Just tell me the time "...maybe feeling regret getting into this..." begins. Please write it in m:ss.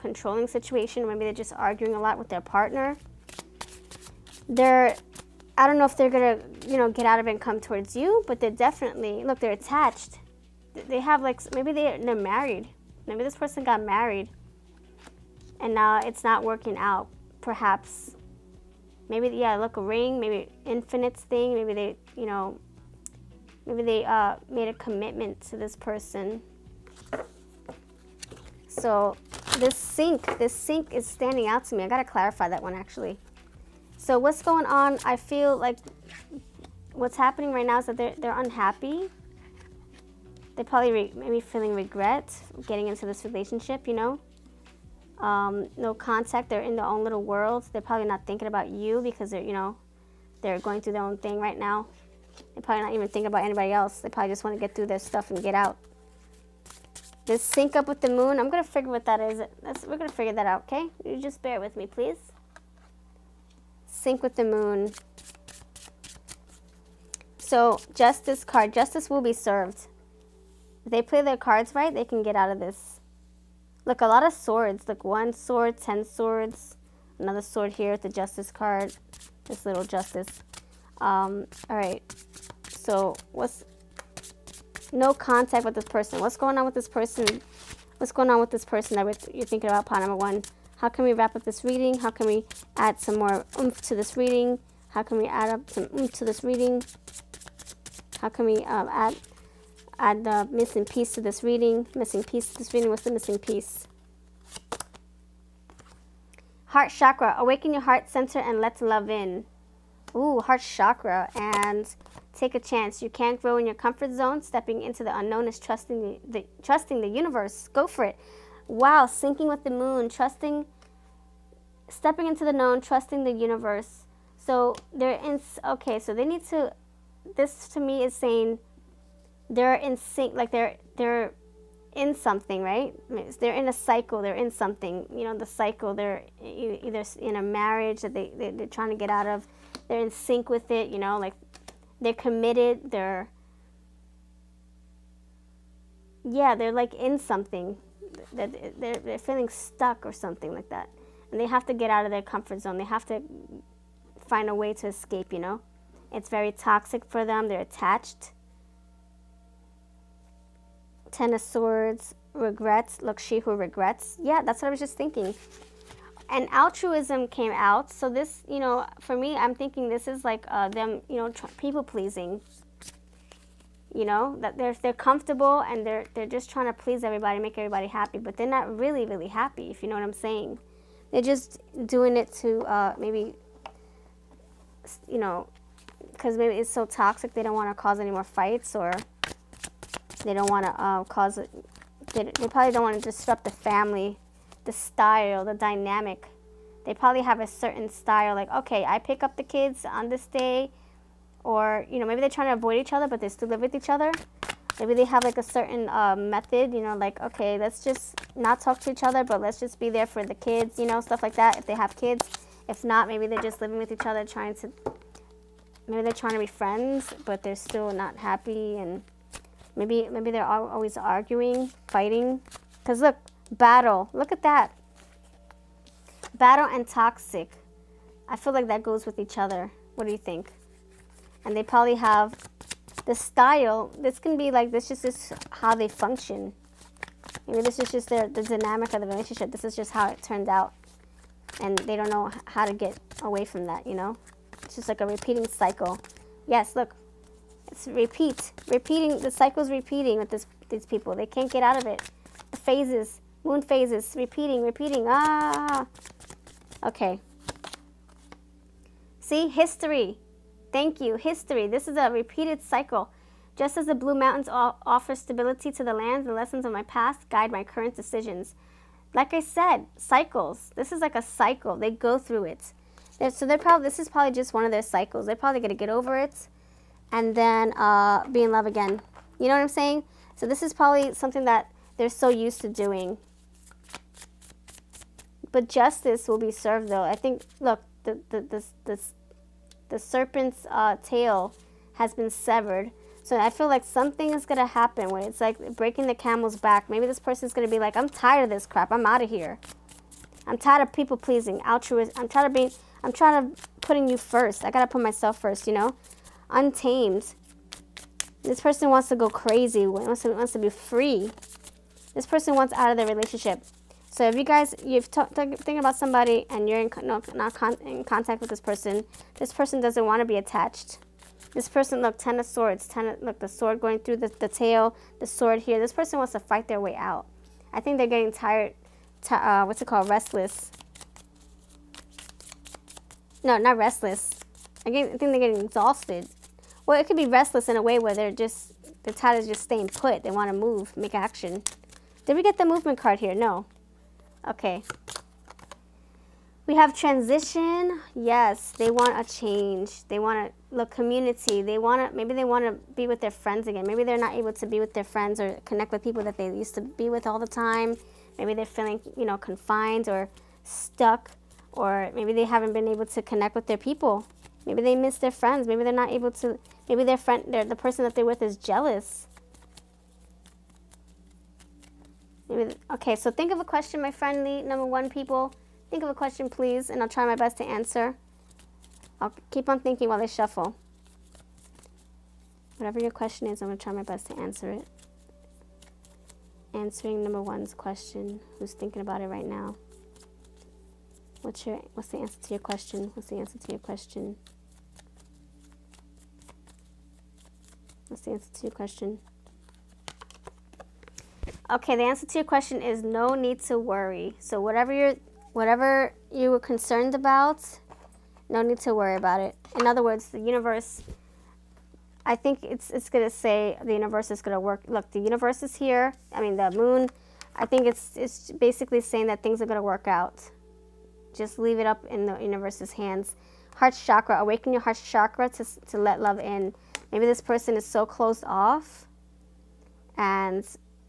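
0:41.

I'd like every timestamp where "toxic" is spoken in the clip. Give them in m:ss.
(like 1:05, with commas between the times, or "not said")
2:36, 3:06, 3:46.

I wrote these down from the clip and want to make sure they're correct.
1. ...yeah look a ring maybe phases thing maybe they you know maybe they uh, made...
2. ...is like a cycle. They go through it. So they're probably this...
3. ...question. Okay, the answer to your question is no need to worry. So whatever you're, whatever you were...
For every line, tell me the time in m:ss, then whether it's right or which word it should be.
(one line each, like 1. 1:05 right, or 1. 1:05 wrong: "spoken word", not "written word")
1. 0:19 wrong: "infinites", not "phases"
2. 4:30 right
3. 6:38 right.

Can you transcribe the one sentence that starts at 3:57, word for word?
Maybe this is just their, the dynamic of the relationship.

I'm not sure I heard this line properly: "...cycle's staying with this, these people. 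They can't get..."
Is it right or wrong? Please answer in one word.
wrong.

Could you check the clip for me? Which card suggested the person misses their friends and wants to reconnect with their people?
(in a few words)
Community.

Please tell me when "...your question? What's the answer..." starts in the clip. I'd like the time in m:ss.
6:32.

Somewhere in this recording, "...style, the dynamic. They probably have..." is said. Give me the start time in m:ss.
3:14.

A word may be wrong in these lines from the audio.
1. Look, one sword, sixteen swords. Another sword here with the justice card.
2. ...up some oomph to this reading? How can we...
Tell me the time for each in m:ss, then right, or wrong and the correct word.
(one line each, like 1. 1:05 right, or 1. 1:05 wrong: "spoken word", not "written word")
1. 1:14 wrong: "ten", not "sixteen"
2. 1:35 right.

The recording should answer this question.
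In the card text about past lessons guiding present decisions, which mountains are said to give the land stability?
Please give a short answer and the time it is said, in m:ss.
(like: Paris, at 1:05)
Blue Mountains, at 4:23.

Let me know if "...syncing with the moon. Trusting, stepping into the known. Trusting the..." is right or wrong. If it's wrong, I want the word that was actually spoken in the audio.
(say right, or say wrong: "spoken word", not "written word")
right.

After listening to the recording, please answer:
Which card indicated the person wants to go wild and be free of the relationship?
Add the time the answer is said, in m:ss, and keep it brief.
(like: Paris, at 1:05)
Untamed, at 5:06.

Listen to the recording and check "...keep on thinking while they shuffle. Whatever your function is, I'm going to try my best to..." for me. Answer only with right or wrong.
wrong.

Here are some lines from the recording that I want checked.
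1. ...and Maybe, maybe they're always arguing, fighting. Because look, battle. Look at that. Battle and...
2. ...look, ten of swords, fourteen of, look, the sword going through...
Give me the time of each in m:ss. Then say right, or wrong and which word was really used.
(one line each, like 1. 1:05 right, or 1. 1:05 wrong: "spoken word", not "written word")
1. 3:38 right
2. 5:22 wrong: "ten", not "fourteen".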